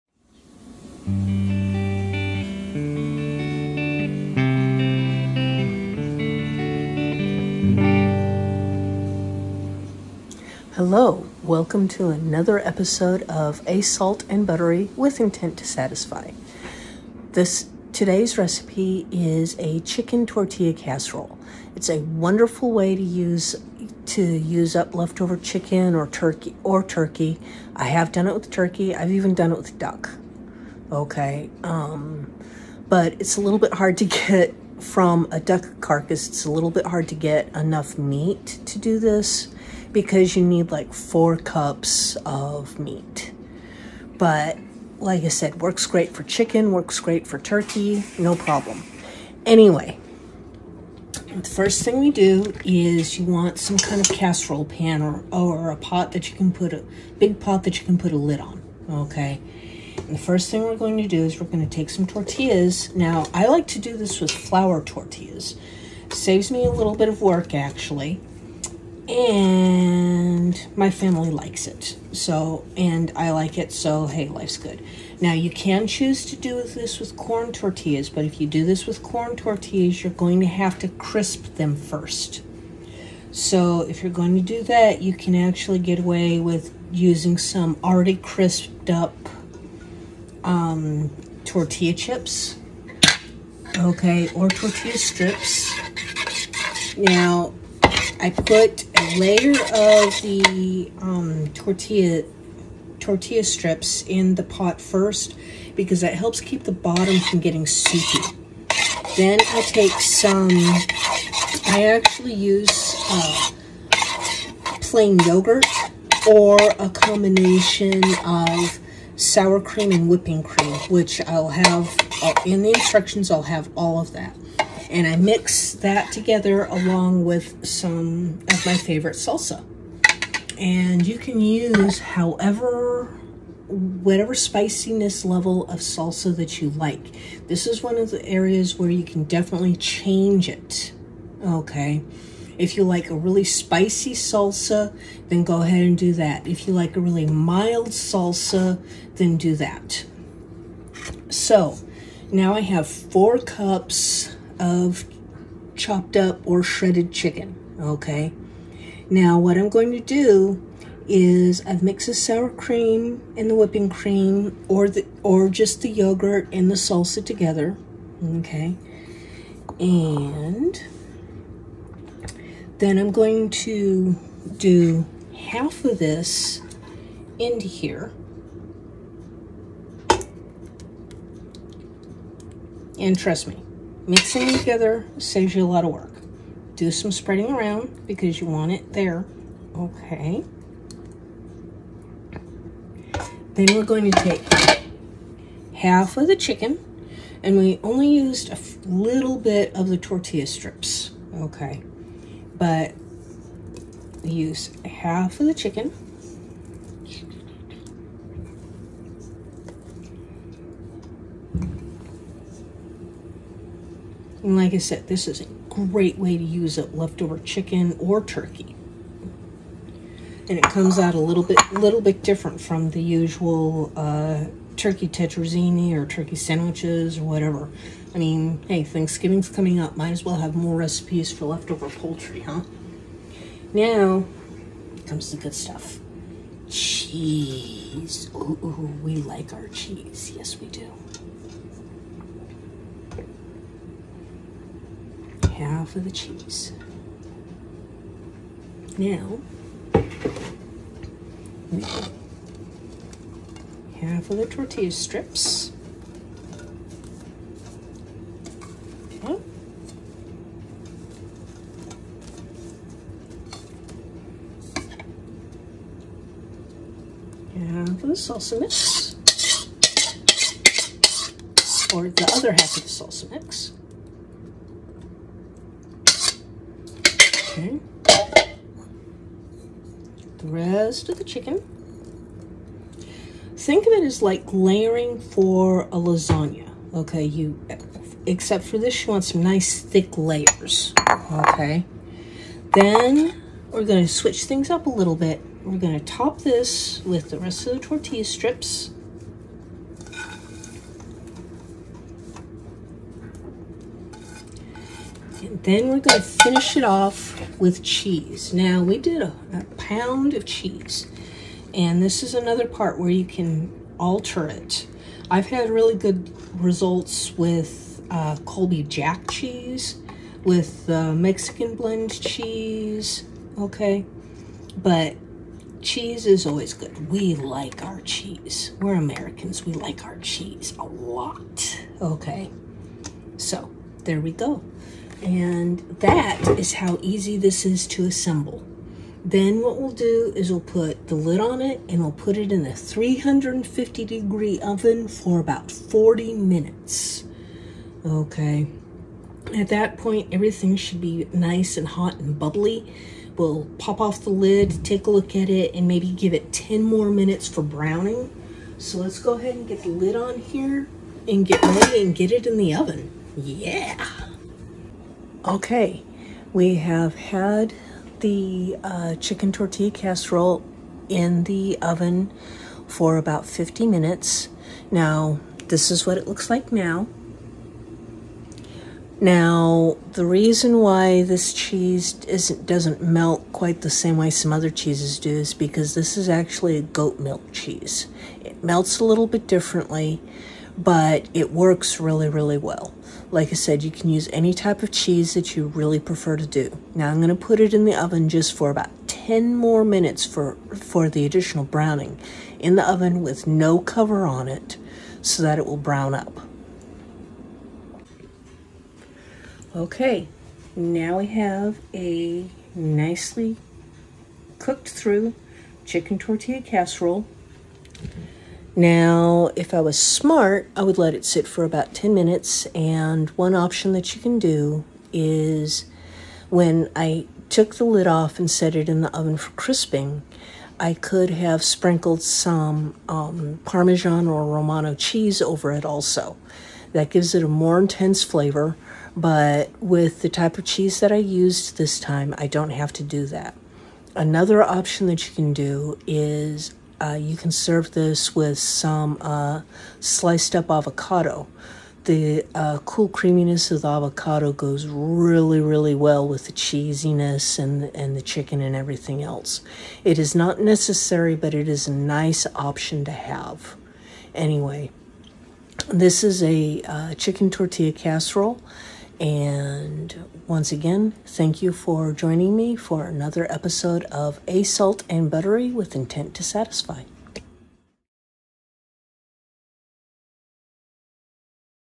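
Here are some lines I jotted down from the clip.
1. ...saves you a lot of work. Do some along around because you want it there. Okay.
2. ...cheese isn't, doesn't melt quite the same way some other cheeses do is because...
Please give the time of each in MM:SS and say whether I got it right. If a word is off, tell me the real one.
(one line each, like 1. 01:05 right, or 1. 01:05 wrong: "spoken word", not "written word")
1. 03:05 wrong: "spreading", not "along"
2. 06:21 right.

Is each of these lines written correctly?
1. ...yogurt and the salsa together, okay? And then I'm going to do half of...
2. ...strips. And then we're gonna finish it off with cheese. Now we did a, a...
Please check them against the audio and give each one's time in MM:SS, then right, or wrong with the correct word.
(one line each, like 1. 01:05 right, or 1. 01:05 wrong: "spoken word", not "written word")
1. 02:45 right
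2. 04:58 right.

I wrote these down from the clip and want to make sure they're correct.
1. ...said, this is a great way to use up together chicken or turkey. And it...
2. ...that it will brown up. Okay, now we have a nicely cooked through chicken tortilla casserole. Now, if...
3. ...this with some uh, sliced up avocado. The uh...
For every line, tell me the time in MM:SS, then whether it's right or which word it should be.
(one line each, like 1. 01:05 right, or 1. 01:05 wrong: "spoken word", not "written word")
1. 03:34 wrong: "leftover", not "together"
2. 06:45 right
3. 07:27 right.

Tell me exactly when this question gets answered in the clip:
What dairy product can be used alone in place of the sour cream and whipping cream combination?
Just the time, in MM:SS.
01:54.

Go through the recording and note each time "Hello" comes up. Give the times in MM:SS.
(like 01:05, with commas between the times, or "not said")
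00:10.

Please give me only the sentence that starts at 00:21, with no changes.
It's a wonderful way to use to use up leftover chicken or turkey or turkey.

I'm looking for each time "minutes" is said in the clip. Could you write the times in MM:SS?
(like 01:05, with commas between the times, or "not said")
05:46, 05:57, 06:13, 06:39, 07:02.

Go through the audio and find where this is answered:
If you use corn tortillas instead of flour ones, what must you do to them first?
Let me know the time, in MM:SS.
01:20.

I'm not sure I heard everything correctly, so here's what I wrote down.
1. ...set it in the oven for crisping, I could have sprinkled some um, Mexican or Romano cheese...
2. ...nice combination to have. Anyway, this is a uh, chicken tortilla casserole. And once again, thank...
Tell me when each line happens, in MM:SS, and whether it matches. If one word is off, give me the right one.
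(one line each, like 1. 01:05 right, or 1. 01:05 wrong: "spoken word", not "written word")
1. 07:08 wrong: "Parmesan", not "Mexican"
2. 07:41 wrong: "option", not "combination".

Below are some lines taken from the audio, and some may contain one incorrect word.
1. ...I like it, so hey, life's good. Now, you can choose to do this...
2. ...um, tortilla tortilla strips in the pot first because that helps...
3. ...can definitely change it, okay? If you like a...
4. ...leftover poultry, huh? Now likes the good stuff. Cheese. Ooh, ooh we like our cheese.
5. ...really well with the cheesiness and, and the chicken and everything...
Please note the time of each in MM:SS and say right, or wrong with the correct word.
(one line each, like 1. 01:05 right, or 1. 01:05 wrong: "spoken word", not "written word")
1. 01:13 right
2. 01:40 right
3. 02:19 right
4. 03:51 wrong: "comes", not "likes"
5. 07:35 right.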